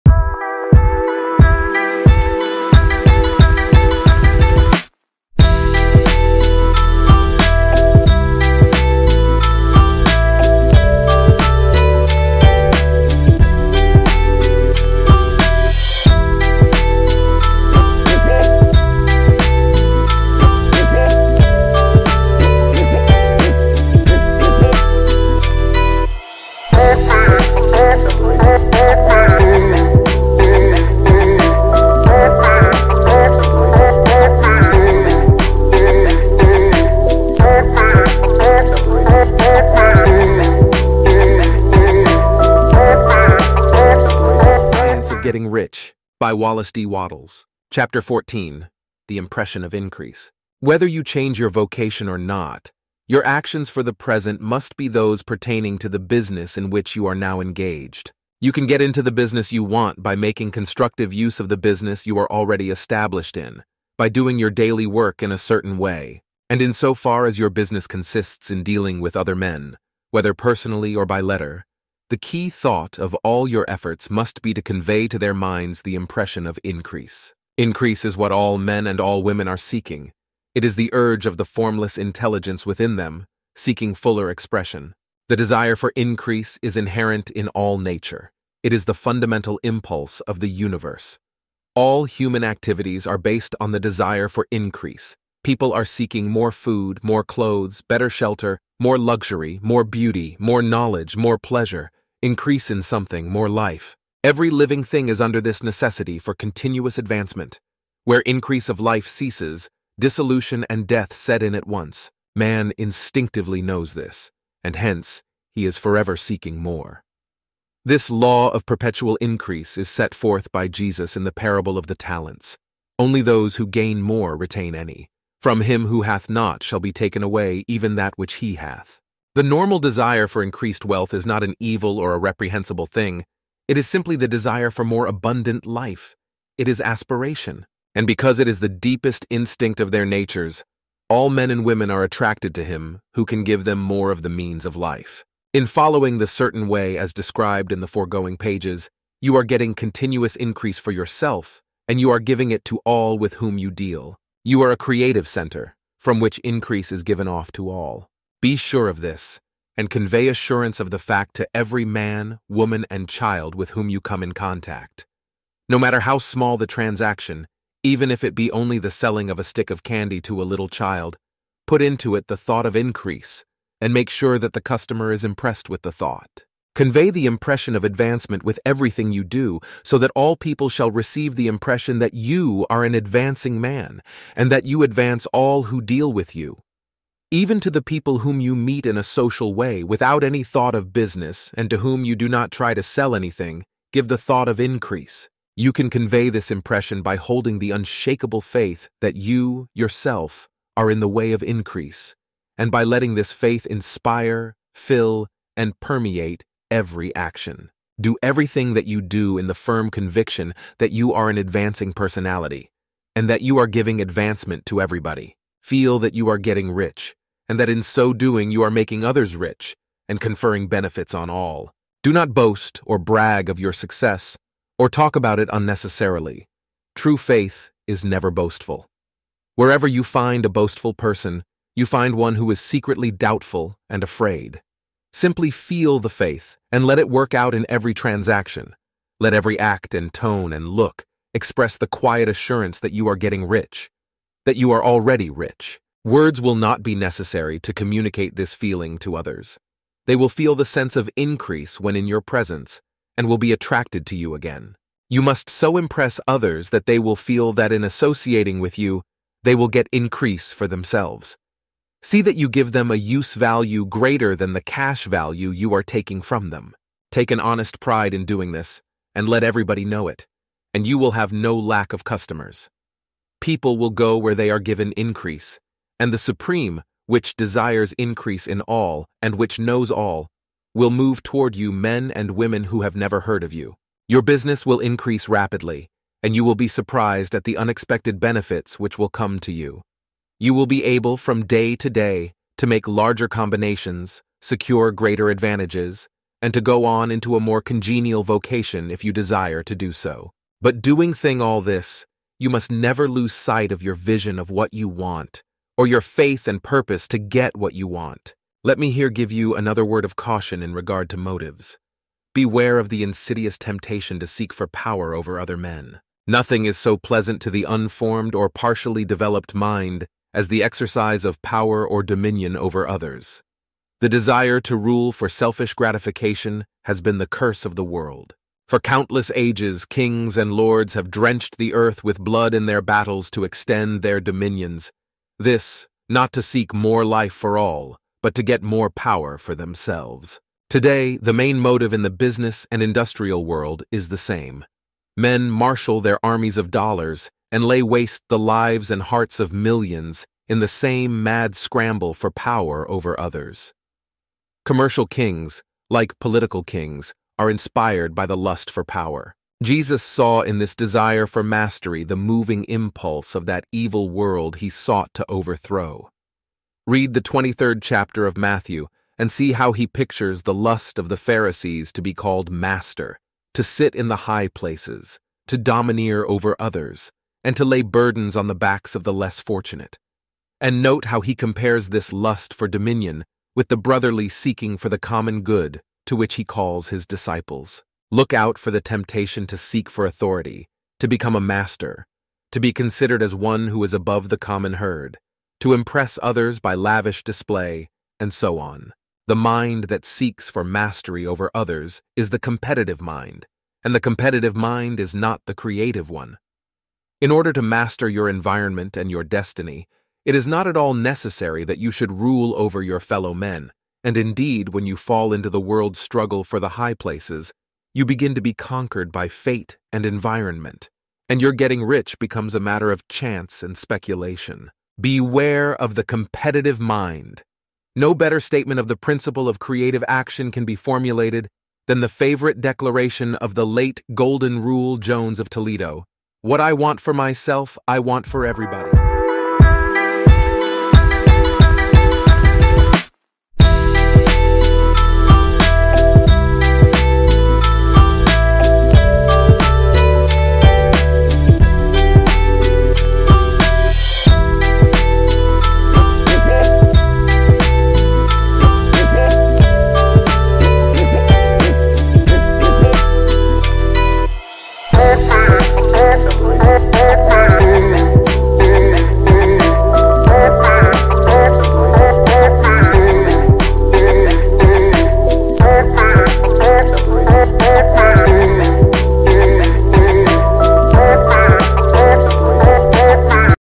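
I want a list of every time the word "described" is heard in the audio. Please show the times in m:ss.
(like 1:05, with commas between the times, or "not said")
2:27.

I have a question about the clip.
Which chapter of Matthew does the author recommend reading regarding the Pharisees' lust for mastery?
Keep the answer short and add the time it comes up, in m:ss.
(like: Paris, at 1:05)
23rd chapter, at 6:07.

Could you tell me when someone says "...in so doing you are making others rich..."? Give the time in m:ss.
3:37.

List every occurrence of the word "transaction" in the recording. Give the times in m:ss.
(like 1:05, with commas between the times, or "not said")
2:46, 3:57.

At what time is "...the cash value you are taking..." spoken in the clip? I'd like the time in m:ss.
4:24.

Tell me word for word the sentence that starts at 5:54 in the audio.
Commercial kings, like political kings, are inspired by the lust for power.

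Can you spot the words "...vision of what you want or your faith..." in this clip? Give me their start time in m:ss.
5:03.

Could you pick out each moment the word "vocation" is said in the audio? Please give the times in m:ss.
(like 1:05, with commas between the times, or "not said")
0:51, 4:58.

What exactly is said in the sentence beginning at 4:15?
You must so impress others that they will feel that in associating with you, they will get increase for themselves.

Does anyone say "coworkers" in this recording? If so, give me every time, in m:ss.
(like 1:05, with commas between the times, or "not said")
not said.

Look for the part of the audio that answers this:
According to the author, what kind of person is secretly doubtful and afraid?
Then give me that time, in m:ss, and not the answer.
3:50.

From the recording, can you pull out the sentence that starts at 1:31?
All human activities are based on the desire for increase.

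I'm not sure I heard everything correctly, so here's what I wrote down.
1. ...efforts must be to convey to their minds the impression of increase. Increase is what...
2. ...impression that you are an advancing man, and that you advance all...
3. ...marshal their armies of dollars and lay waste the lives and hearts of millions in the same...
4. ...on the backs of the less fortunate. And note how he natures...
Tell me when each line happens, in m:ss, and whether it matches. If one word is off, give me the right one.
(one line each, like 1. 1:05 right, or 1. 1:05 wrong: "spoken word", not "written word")
1. 1:13 right
2. 3:01 right
3. 5:45 right
4. 6:18 wrong: "compares", not "natures".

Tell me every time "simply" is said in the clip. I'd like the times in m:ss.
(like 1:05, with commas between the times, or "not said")
2:13, 3:55.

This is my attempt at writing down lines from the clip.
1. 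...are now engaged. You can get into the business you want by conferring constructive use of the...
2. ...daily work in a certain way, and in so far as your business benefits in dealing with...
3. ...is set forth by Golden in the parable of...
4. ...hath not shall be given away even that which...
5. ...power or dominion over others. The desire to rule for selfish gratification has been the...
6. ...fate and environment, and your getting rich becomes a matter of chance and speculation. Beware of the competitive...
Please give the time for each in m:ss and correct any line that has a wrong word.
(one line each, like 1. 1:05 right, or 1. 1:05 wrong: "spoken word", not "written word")
1. 0:57 wrong: "making", not "conferring"
2. 1:04 wrong: "consists", not "benefits"
3. 1:59 wrong: "Jesus", not "Golden"
4. 2:06 wrong: "taken", not "given"
5. 5:21 right
6. 6:59 right.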